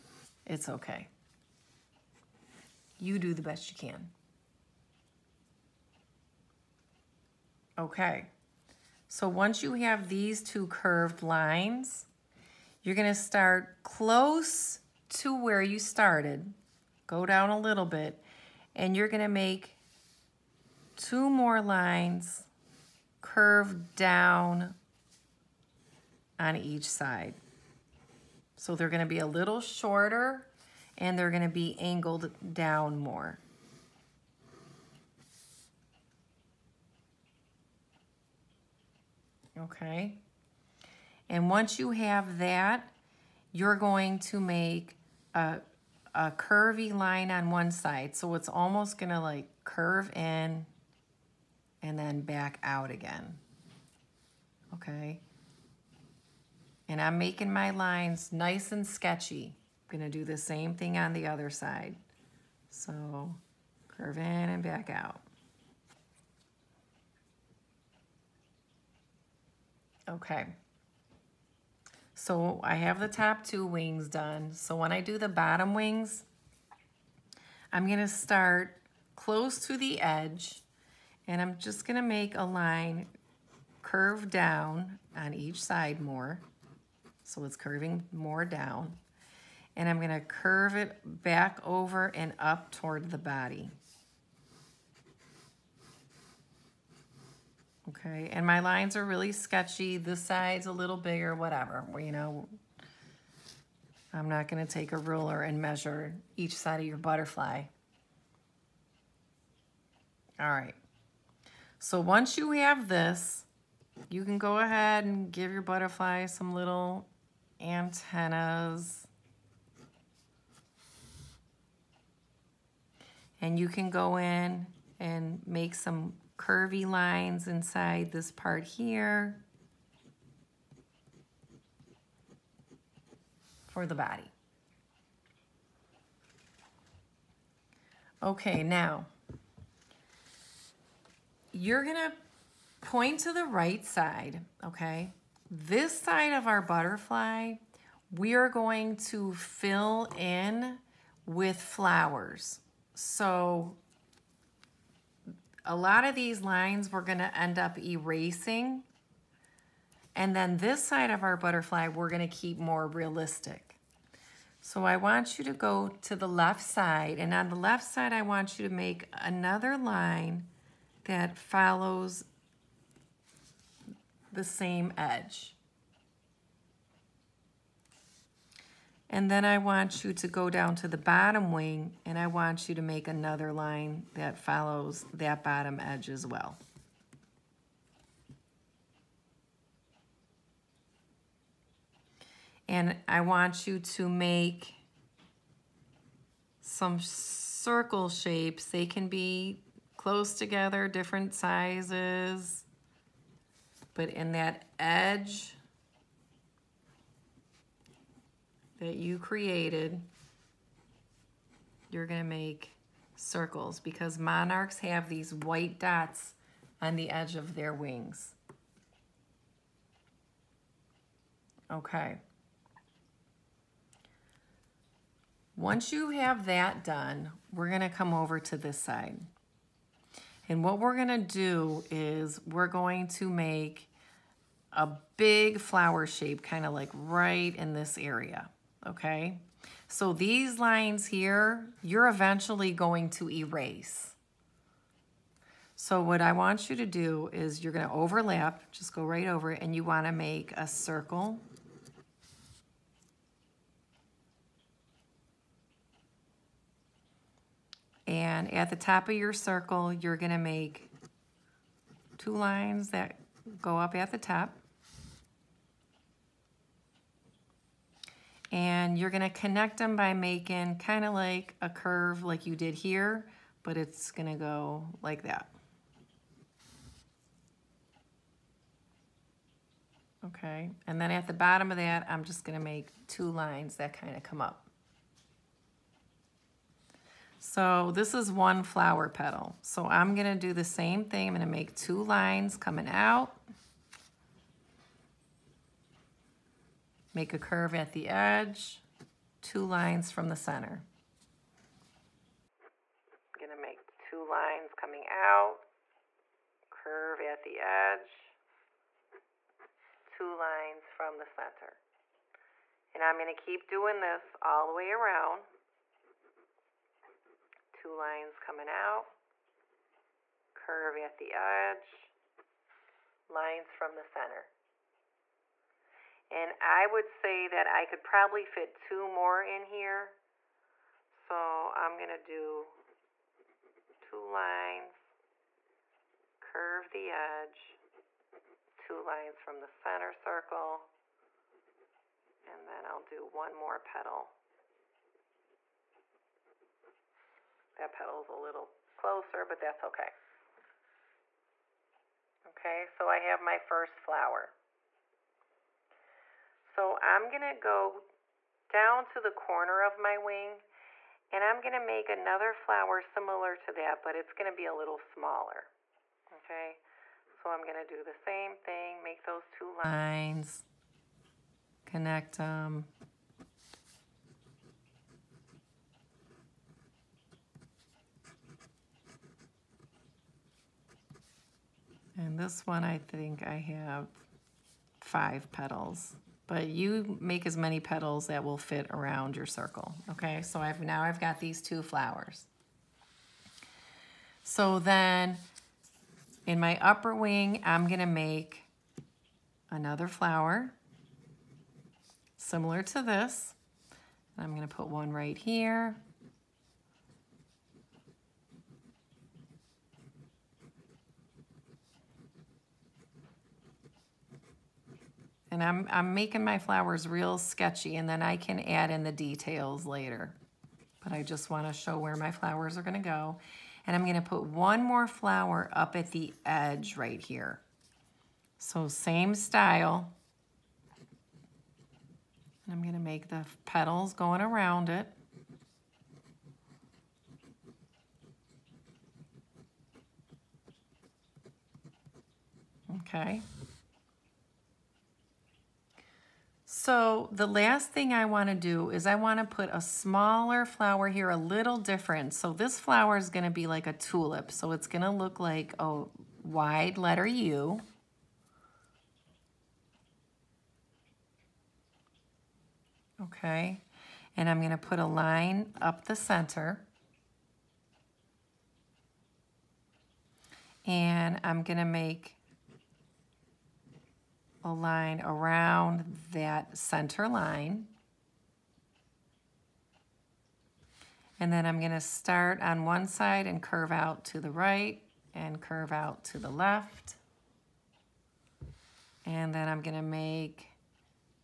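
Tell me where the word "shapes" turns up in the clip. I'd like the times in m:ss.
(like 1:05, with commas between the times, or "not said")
3:18, 3:56.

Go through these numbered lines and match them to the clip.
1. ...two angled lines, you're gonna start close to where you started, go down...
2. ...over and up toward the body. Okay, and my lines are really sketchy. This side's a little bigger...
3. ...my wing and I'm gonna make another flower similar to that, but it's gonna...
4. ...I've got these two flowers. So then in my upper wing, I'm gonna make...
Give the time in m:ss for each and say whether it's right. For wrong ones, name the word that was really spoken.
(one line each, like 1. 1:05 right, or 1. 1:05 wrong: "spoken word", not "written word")
1. 0:10 wrong: "curved", not "angled"
2. 1:31 right
3. 5:59 right
4. 6:31 right.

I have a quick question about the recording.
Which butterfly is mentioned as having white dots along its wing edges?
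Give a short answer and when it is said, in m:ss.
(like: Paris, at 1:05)
monarchs, at 3:34.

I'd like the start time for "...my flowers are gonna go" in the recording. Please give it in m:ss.
7:02.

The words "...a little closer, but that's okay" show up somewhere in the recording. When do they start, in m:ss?
5:48.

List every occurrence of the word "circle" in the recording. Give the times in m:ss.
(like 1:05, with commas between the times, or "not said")
3:17, 3:33, 4:10, 4:19, 5:40, 6:29.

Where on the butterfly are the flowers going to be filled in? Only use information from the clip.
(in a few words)
the right side.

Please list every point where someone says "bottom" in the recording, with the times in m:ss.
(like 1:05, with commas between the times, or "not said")
1:15, 3:00, 3:05, 4:41.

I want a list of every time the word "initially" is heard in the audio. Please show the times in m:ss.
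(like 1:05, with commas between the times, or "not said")
not said.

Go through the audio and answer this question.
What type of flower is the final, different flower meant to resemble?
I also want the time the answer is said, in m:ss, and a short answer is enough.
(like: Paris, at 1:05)
a tulip, at 7:33.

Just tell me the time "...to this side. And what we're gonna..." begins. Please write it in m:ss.
3:48.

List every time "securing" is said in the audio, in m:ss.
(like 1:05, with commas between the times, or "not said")
not said.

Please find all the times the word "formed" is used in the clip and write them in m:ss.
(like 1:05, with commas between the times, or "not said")
not said.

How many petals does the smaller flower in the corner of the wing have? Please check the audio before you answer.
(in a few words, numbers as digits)
5.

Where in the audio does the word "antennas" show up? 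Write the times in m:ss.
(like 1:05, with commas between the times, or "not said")
1:57.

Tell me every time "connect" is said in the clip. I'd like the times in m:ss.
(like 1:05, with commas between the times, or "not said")
4:29, 6:11.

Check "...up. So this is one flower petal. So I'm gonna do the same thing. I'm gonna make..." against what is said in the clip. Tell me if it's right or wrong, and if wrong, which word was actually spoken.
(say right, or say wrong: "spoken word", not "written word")
right.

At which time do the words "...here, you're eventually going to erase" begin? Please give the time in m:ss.
4:01.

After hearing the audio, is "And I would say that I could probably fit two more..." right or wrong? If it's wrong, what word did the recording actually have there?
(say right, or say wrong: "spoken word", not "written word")
right.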